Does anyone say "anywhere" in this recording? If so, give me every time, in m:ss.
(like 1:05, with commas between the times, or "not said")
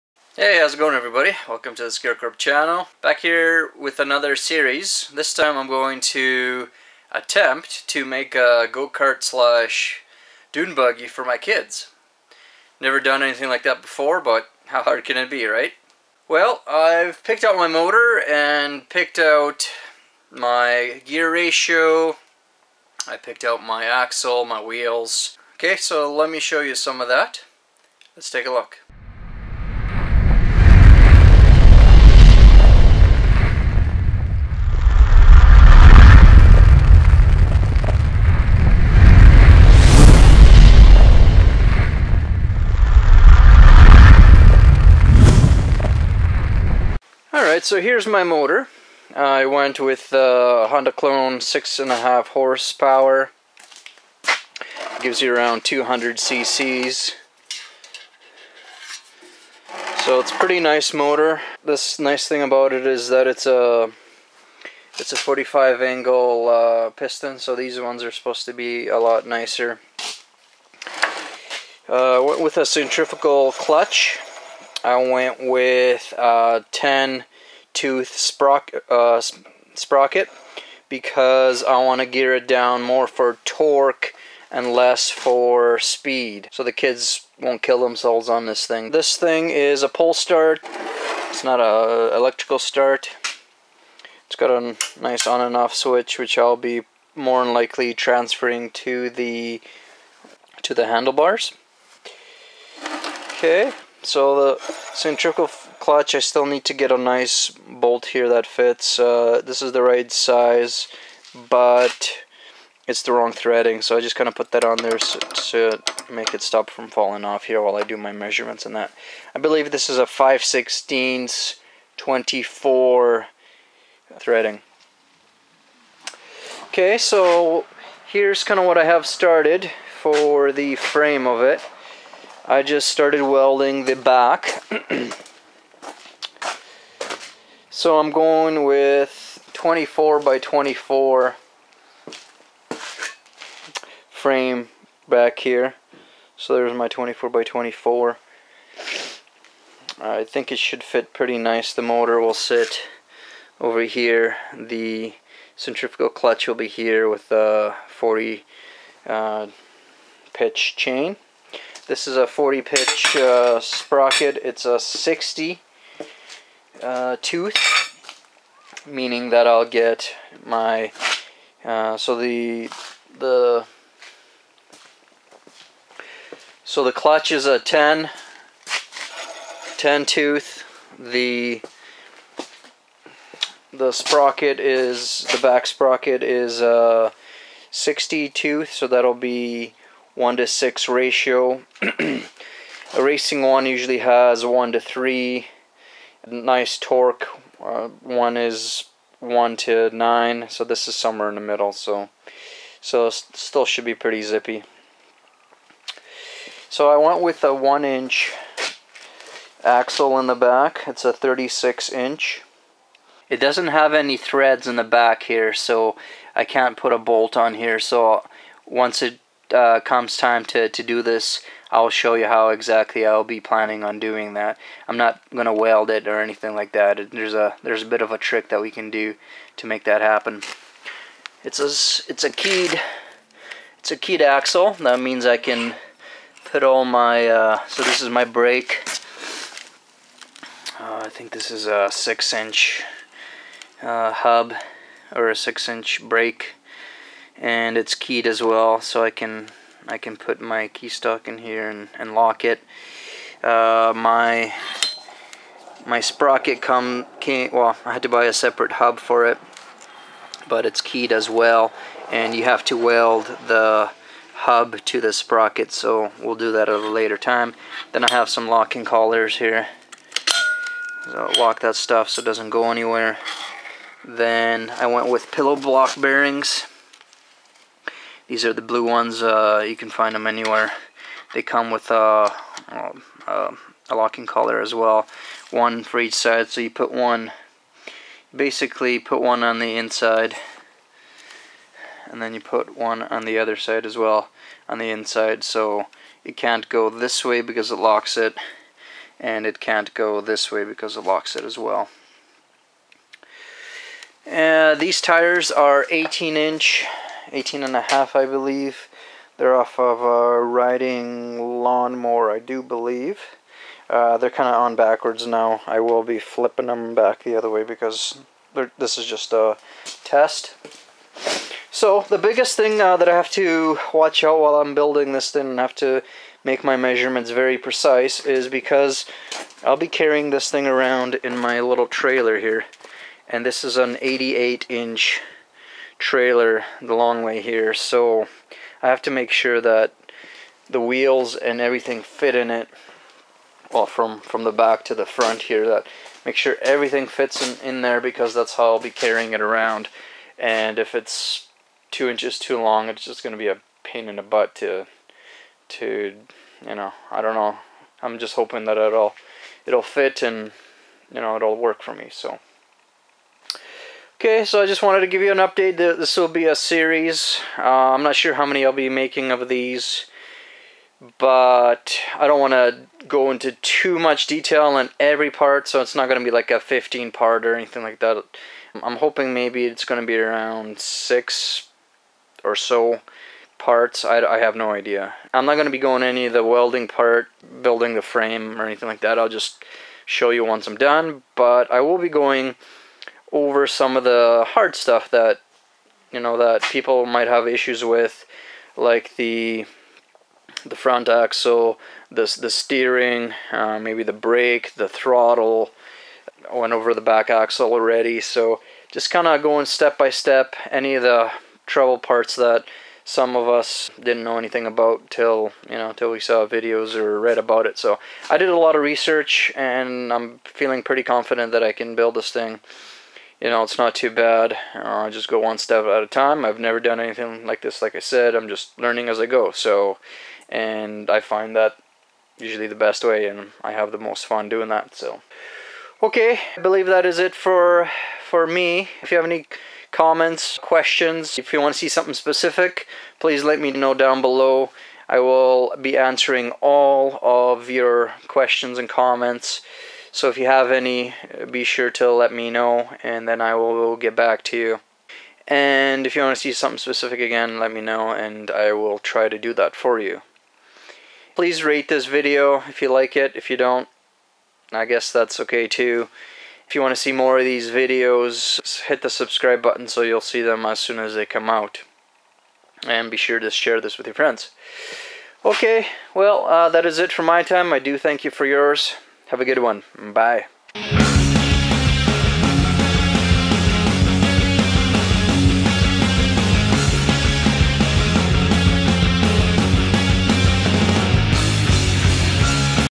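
4:32, 4:40.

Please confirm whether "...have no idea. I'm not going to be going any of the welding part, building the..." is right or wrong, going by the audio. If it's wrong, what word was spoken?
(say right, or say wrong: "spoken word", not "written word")
right.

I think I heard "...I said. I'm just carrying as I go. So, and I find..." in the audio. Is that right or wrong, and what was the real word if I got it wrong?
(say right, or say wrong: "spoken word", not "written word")
wrong: "learning", not "carrying".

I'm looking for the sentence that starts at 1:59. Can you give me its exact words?
I believe this is a 5 16 24 threading.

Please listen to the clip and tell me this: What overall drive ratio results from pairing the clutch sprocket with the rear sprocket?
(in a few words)
1 to 6.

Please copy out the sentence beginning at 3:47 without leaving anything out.
There's a there's a bit of a trick that we can do to make that happen.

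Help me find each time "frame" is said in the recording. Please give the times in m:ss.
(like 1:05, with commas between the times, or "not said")
2:10, 2:24, 6:28.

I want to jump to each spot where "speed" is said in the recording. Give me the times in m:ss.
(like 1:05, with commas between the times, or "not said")
1:25.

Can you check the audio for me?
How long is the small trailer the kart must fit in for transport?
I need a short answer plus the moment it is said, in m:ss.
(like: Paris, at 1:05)
88 inch, at 5:34.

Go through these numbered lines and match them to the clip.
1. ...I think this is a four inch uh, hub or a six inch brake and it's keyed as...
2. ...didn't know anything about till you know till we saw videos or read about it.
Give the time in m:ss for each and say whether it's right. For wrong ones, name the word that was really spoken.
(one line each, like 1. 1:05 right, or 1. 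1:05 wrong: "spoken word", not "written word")
1. 4:01 wrong: "six", not "four"
2. 6:53 right.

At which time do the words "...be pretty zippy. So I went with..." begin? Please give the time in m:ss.
3:23.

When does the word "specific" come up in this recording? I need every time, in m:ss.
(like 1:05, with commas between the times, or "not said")
7:22, 7:36.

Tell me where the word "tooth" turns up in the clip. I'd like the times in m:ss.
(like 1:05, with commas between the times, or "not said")
1:17, 2:47, 3:00, 3:08.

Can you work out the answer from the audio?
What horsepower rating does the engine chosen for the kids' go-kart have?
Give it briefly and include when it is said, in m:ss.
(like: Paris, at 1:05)
6.5 horsepower, at 0:51.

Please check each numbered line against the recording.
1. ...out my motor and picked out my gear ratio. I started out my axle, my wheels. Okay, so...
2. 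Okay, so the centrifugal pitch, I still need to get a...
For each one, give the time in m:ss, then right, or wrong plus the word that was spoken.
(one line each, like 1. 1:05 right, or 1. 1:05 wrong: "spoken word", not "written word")
1. 0:17 wrong: "picked", not "started"
2. 1:43 wrong: "clutch", not "pitch".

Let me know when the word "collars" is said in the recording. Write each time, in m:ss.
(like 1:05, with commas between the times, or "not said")
4:28, 4:44.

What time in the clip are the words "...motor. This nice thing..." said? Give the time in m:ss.
1:00.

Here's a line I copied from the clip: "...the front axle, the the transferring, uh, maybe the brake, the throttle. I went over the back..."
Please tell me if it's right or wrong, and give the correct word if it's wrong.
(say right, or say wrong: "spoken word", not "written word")
wrong: "steering", not "transferring".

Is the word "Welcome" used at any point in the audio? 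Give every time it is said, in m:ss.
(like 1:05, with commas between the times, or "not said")
0:01.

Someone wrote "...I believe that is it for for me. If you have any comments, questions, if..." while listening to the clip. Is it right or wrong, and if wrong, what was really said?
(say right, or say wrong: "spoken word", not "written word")
right.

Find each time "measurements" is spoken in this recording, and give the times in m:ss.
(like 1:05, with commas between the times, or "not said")
1:58, 5:26.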